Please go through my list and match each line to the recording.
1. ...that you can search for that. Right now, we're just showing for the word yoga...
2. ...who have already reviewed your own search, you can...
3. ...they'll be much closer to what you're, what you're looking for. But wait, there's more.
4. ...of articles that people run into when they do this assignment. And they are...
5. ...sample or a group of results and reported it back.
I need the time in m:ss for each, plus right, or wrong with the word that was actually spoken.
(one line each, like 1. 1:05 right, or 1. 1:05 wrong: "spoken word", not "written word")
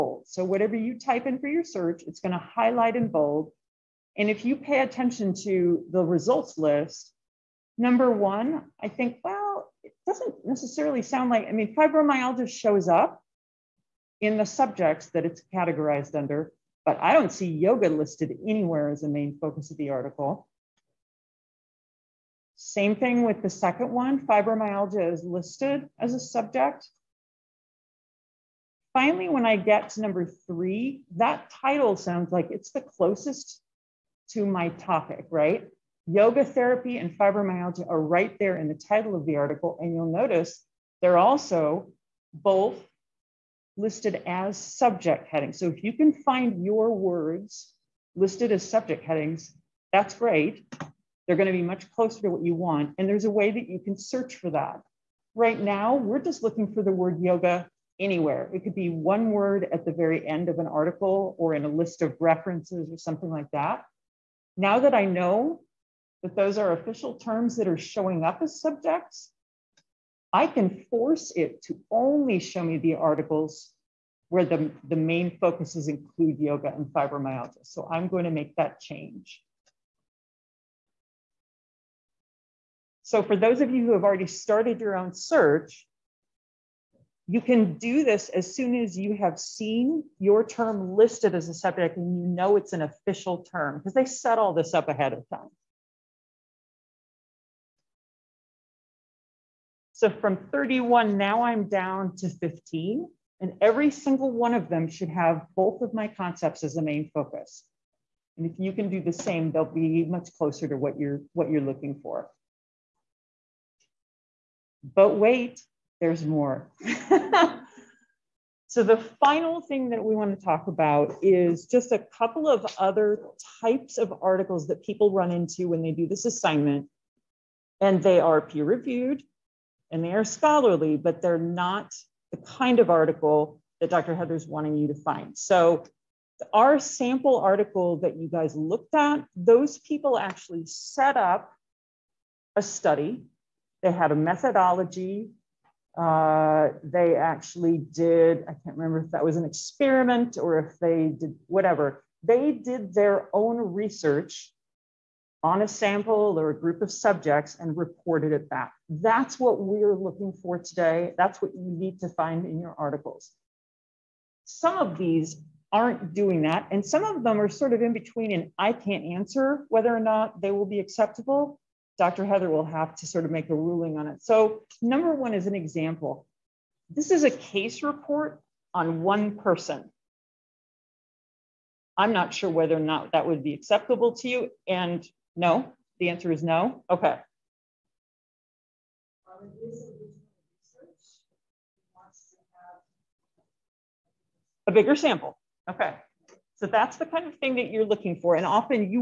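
1. 0:53 wrong: "looking", not "showing"
2. 1:23 wrong: "started", not "reviewed"
3. 1:49 right
4. 2:03 right
5. 2:35 wrong: "subjects", not "results".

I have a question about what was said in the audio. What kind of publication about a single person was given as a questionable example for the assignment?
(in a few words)
Case report.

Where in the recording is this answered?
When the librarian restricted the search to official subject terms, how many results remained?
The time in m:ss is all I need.
1:42.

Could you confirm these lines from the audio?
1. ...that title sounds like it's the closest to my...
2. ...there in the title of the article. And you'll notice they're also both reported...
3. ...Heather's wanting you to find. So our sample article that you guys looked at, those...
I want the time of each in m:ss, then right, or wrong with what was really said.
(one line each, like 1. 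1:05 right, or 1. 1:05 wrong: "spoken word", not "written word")
1. 0:31 right
2. 0:38 wrong: "listed", not "reported"
3. 2:14 right.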